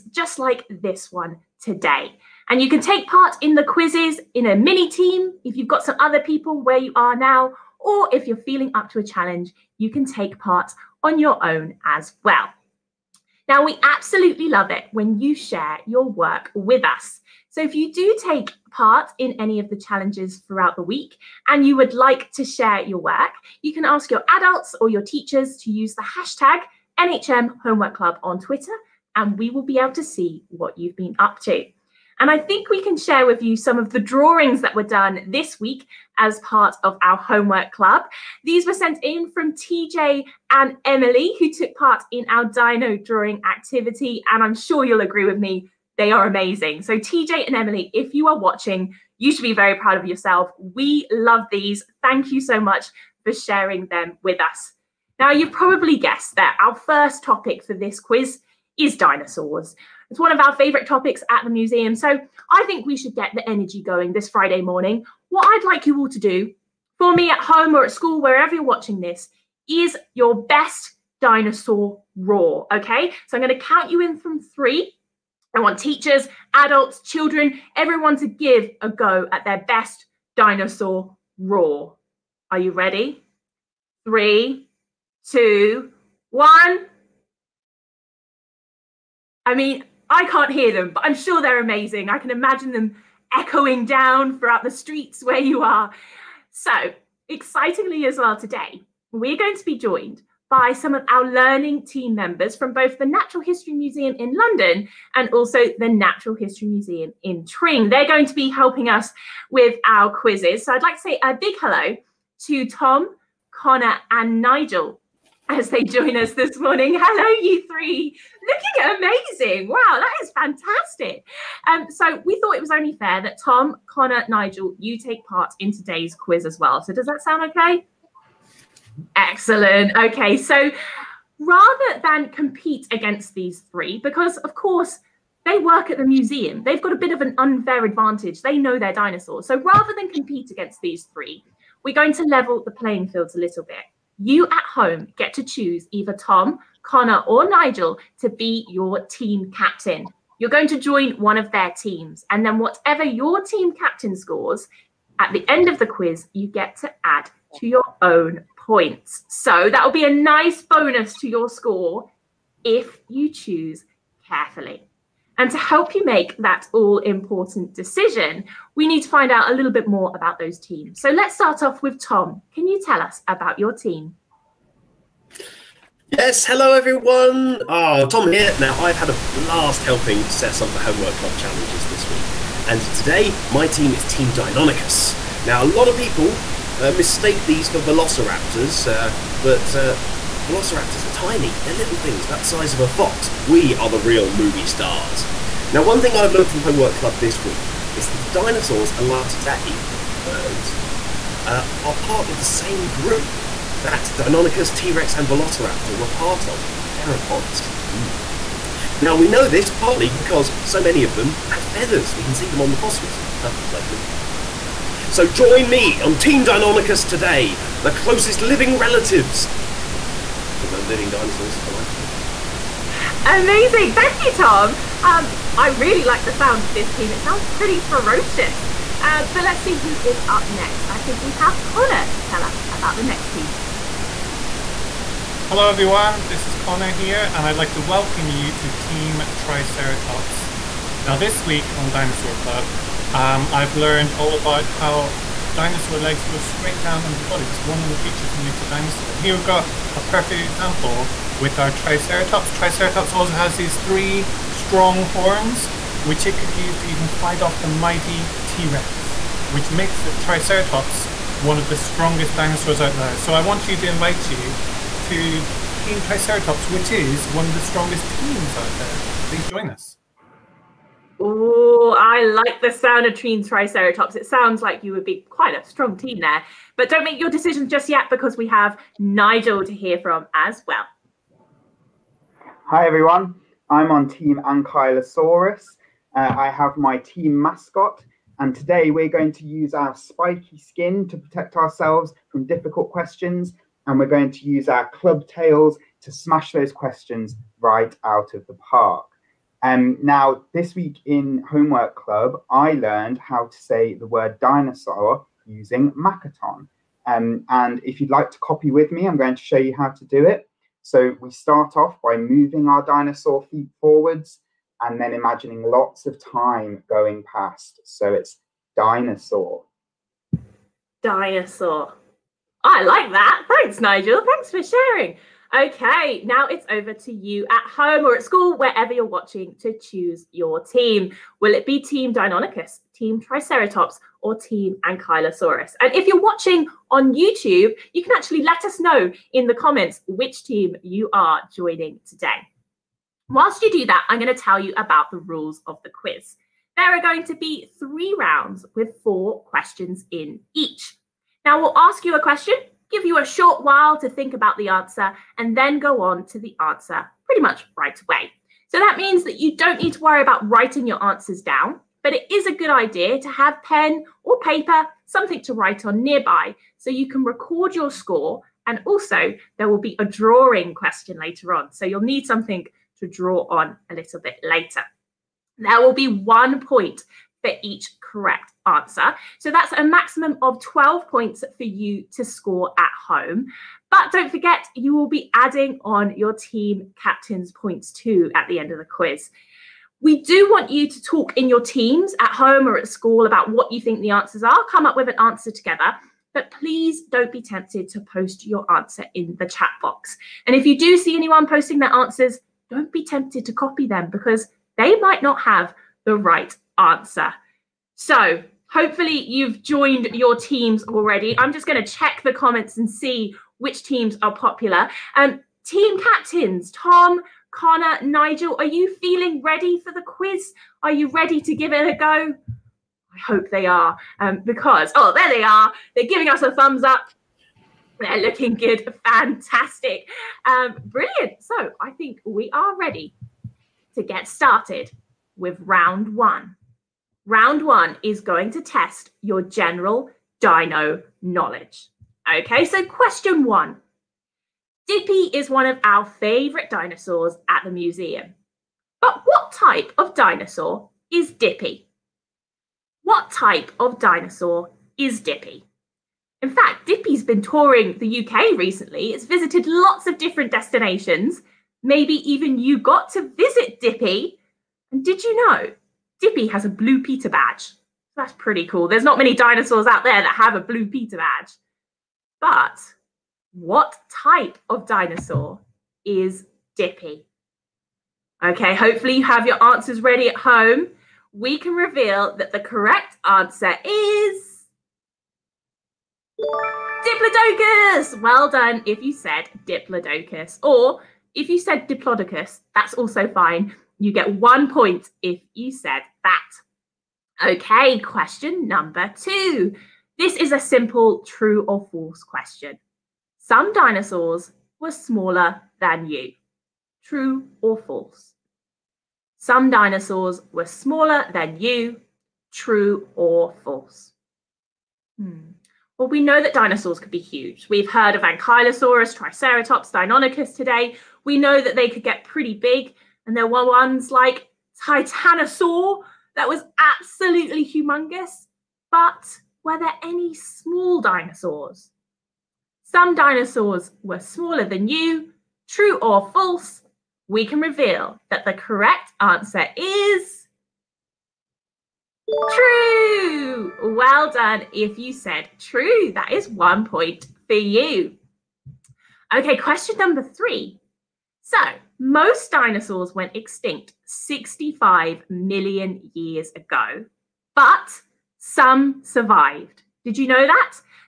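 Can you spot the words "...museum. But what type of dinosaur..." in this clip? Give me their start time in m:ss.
7:27.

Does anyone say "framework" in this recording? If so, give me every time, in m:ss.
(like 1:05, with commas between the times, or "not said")
not said.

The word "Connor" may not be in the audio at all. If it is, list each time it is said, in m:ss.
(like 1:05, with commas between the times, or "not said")
1:53, 2:03, 2:26, 3:51, 3:56, 6:57.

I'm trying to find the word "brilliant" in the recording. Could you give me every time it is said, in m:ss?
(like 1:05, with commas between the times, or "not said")
7:10.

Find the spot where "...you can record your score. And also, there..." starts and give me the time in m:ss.
6:06.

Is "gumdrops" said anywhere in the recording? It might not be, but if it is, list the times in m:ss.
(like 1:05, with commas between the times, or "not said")
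not said.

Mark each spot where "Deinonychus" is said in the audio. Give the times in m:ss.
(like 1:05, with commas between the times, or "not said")
3:04, 3:24, 3:36, 5:32, 8:39.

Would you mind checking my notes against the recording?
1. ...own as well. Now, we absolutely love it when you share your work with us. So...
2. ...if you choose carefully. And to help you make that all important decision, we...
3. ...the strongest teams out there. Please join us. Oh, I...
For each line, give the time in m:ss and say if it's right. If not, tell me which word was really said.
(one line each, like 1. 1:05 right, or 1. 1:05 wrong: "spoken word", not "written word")
1. 0:11 right
2. 2:42 right
3. 4:27 right.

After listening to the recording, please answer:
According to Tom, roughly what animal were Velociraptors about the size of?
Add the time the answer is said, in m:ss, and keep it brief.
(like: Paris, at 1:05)
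A fox, at 3:12.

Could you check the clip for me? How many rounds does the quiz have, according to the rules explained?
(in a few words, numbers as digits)
3.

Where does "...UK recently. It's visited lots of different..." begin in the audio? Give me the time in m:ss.
7:38.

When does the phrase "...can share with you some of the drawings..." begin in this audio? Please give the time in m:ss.
0:32.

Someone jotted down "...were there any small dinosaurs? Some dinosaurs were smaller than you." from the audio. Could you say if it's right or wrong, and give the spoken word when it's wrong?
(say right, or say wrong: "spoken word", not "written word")
right.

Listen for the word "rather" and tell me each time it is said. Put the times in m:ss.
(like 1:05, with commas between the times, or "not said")
2:11, 2:19.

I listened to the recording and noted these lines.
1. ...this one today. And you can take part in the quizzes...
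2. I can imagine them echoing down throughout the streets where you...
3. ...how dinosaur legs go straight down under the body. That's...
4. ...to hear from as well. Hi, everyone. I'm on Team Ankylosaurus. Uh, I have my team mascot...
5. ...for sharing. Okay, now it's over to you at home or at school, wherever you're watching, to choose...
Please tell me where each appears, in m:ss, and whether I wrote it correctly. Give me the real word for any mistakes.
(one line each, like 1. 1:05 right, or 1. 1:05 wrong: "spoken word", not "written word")
1. 0:00 right
2. 1:32 right
3. 4:04 right
4. 4:39 right
5. 5:24 right.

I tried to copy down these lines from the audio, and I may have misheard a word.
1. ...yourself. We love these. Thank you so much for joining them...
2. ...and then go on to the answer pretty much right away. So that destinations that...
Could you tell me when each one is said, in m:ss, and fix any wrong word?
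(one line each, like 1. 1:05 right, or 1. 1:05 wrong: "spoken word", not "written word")
1. 0:50 wrong: "sharing", not "joining"
2. 5:55 wrong: "means", not "destinations".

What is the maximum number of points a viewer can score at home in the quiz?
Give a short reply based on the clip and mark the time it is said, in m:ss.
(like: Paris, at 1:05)
12, at 6:20.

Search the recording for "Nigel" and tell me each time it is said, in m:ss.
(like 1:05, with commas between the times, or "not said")
1:54, 2:04, 2:27, 4:38, 5:23, 6:58.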